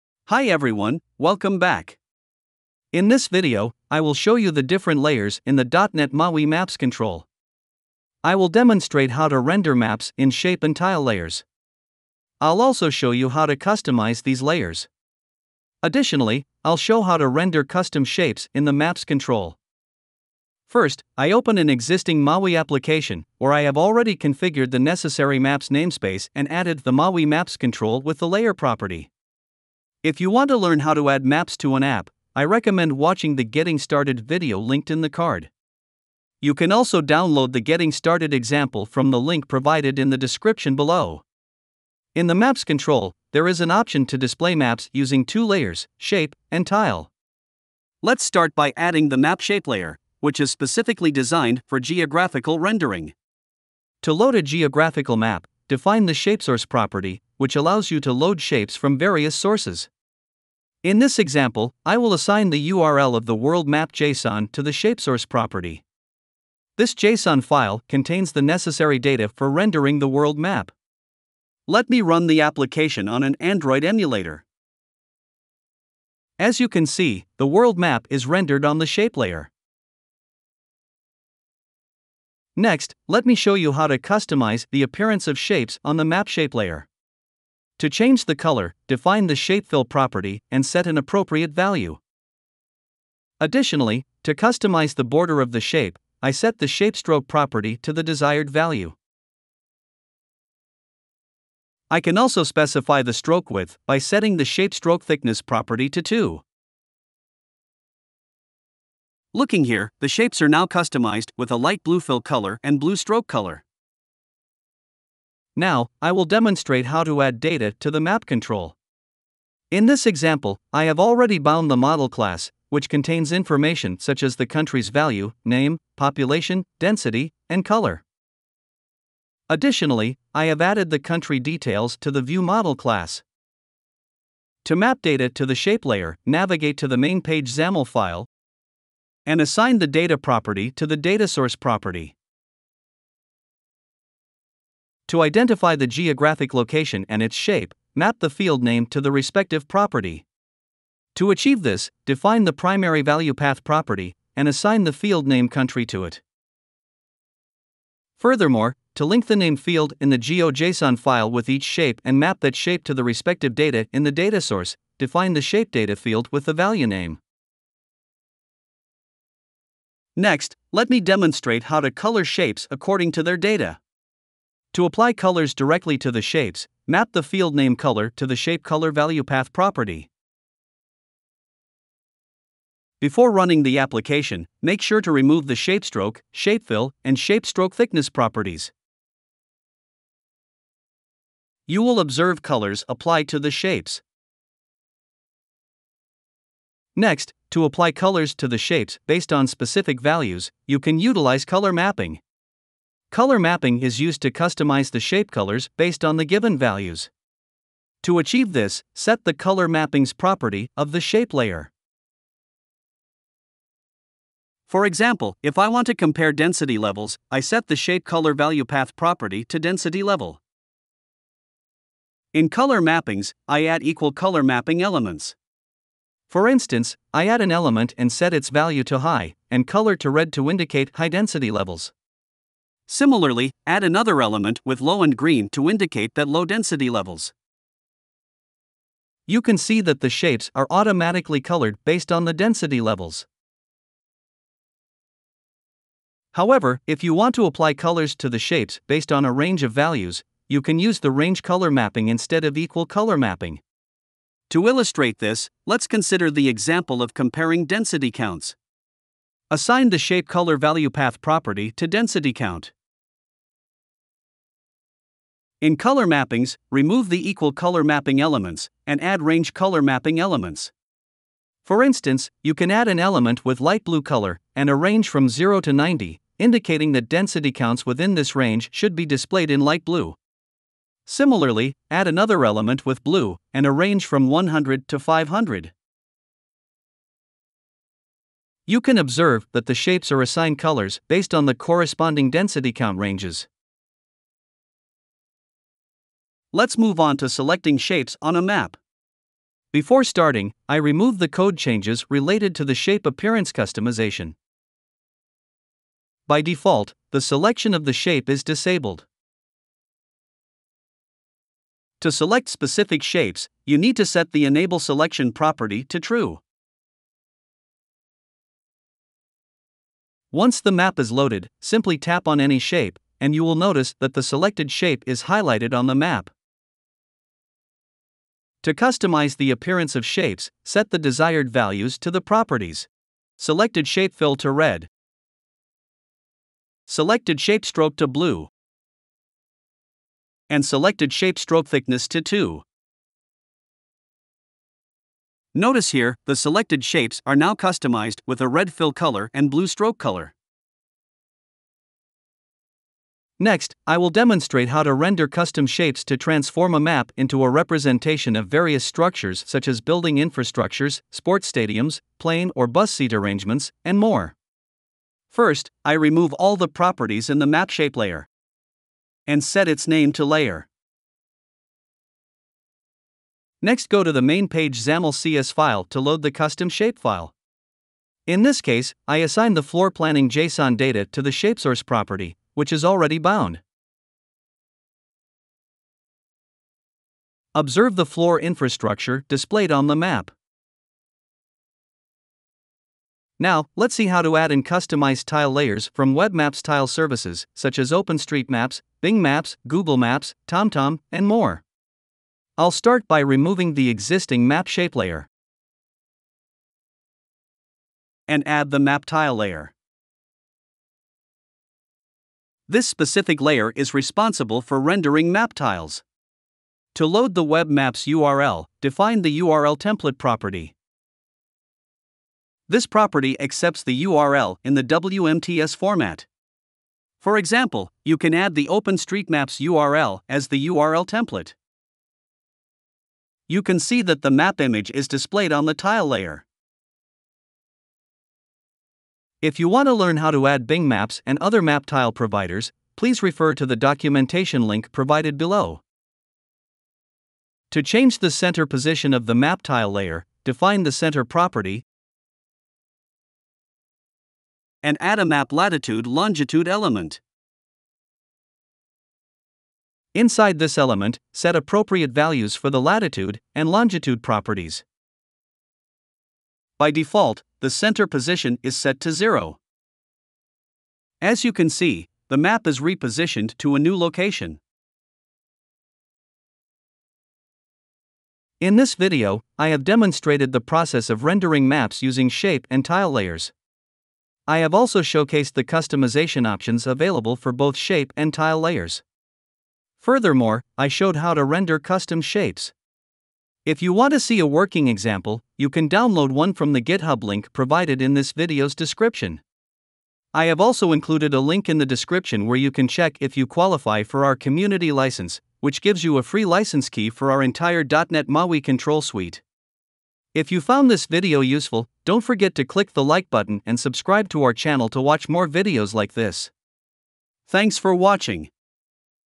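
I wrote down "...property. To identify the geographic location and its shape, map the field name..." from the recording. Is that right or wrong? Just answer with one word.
right.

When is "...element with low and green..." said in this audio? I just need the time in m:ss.
3:54.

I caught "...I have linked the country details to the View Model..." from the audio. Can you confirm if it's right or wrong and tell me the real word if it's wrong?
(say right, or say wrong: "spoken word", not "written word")
wrong: "added", not "linked".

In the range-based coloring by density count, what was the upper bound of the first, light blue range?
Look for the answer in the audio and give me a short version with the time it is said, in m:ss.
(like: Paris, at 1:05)
90, at 4:35.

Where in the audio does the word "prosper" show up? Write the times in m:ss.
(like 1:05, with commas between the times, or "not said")
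not said.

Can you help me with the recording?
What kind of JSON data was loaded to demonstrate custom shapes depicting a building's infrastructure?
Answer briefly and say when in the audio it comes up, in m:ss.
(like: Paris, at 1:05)
floor planning, at 6:19.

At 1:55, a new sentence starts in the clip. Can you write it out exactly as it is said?
Now, I will demonstrate how to add data to the map control.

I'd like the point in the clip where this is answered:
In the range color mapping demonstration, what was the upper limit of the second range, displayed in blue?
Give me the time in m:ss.
4:44.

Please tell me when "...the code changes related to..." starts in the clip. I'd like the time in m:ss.
5:01.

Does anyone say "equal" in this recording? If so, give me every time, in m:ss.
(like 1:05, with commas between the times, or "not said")
3:43, 4:12, 4:27.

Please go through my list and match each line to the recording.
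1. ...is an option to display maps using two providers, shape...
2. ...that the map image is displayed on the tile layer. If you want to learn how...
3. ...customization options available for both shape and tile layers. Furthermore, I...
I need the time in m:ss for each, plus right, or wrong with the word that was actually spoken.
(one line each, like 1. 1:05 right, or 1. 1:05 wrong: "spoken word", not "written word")
1. 0:43 wrong: "layers", not "providers"
2. 7:14 right
3. 8:05 right.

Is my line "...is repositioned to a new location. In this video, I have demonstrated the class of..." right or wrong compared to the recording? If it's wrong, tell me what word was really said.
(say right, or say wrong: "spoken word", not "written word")
wrong: "process", not "class".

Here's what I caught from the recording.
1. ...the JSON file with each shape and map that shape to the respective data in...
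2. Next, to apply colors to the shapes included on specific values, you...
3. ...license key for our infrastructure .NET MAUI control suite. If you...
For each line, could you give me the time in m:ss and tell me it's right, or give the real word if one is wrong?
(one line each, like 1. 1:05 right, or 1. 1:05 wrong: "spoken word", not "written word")
1. 2:40 wrong: "GeoJSON", not "JSON"
2. 3:16 wrong: "based", not "included"
3. 8:26 wrong: "entire", not "infrastructure".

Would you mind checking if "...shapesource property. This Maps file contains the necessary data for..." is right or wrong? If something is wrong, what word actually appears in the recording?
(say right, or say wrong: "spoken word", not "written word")
wrong: "JSON", not "Maps".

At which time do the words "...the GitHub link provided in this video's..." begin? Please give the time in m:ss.
8:16.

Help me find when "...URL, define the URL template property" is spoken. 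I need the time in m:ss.
6:58.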